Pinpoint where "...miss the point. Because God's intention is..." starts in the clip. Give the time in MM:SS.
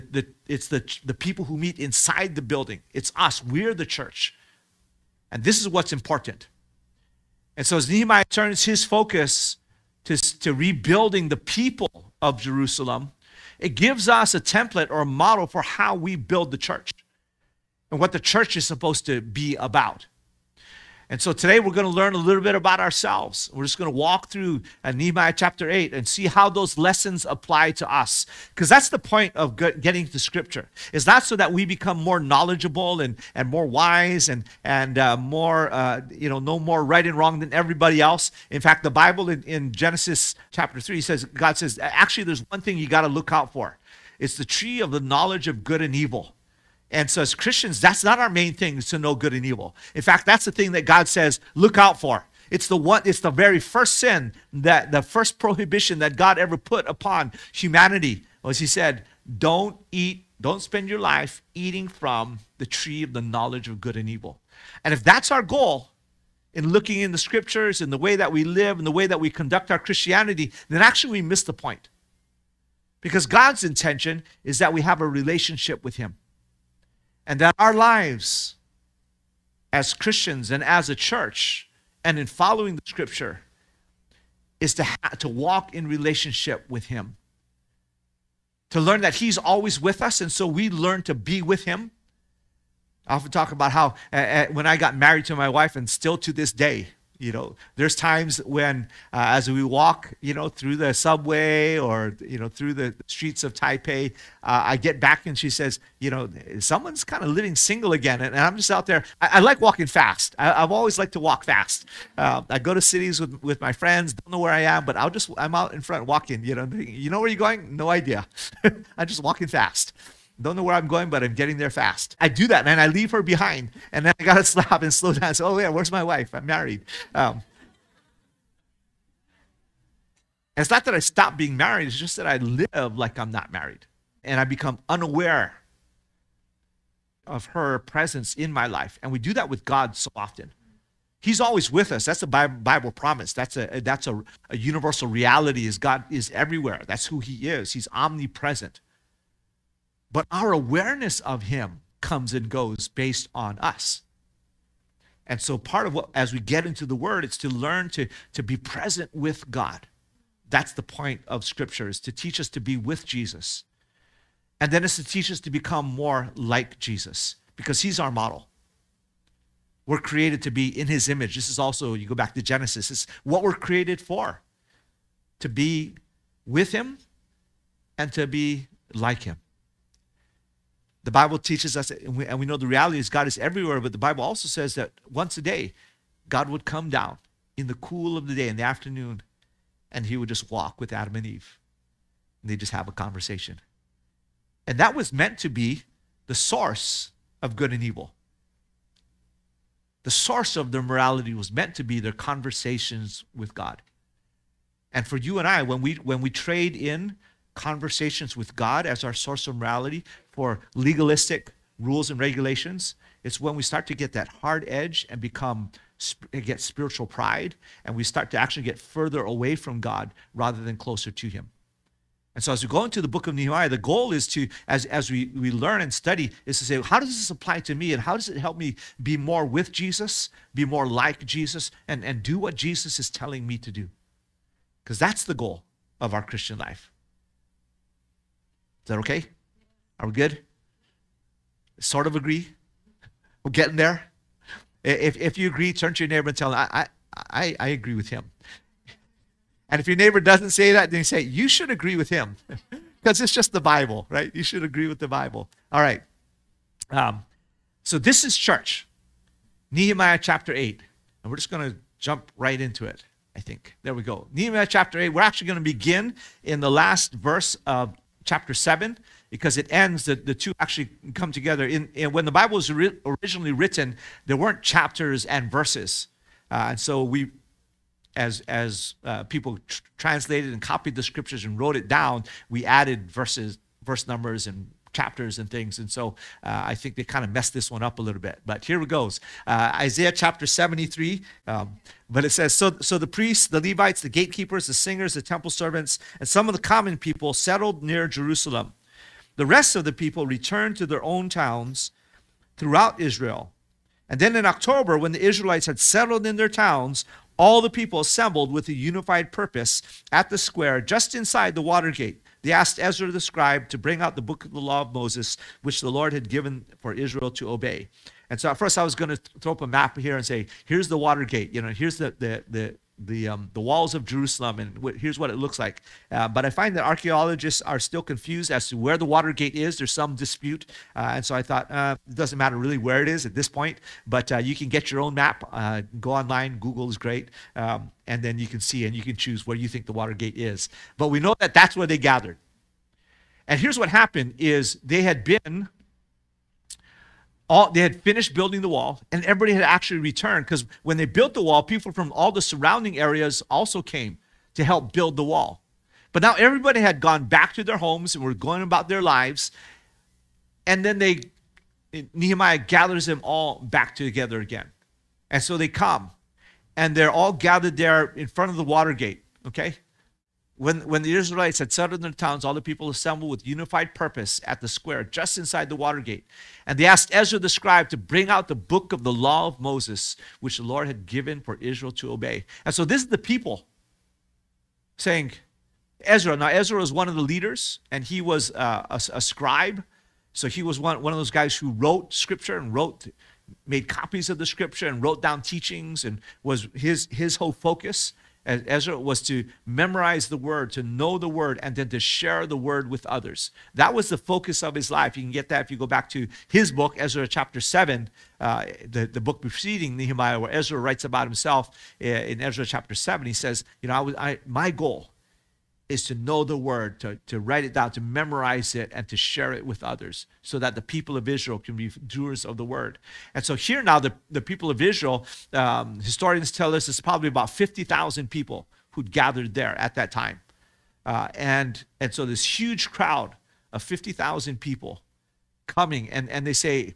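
01:11.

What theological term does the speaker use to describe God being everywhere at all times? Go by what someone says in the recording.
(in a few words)
Omnipresent.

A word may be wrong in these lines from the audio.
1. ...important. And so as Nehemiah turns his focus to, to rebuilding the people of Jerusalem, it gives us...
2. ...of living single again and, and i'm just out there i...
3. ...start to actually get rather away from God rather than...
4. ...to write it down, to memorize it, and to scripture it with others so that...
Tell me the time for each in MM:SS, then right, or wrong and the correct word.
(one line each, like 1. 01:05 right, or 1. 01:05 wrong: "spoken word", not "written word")
1. 00:05 right
2. 01:47 right
3. 03:38 wrong: "further", not "rather"
4. 06:57 wrong: "share", not "scripture".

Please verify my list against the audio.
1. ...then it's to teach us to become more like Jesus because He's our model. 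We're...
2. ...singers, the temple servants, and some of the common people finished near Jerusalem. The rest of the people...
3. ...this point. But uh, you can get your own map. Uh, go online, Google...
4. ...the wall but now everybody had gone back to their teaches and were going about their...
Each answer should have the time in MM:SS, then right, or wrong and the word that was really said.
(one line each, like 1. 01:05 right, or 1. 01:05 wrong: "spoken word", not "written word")
1. 02:44 right
2. 04:54 wrong: "settled", not "finished"
3. 05:33 right
4. 05:55 wrong: "homes", not "teaches".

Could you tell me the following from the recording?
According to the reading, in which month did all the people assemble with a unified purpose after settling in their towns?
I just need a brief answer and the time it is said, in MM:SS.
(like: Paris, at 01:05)
October, at 05:04.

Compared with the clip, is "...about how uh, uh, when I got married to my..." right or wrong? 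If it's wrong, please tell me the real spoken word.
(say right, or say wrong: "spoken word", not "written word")
right.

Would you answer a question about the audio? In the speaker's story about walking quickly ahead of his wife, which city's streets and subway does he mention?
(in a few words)
Taipei.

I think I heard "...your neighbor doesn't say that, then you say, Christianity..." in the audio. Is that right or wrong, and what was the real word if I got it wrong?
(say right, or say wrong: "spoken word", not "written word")
wrong: "You", not "Christianity".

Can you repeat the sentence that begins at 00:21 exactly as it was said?
And so today we're going to learn a little bit about ourselves.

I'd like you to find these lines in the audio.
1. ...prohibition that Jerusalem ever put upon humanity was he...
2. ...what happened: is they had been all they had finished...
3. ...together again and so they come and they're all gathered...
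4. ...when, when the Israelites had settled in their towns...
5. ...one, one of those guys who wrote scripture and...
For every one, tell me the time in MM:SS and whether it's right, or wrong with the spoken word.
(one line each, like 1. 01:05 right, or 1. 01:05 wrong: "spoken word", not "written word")
1. 00:55 wrong: "God", not "Jerusalem"
2. 05:43 right
3. 06:03 right
4. 06:10 right
5. 06:30 right.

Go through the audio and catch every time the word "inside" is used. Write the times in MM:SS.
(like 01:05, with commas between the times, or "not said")
00:01, 05:11, 06:15.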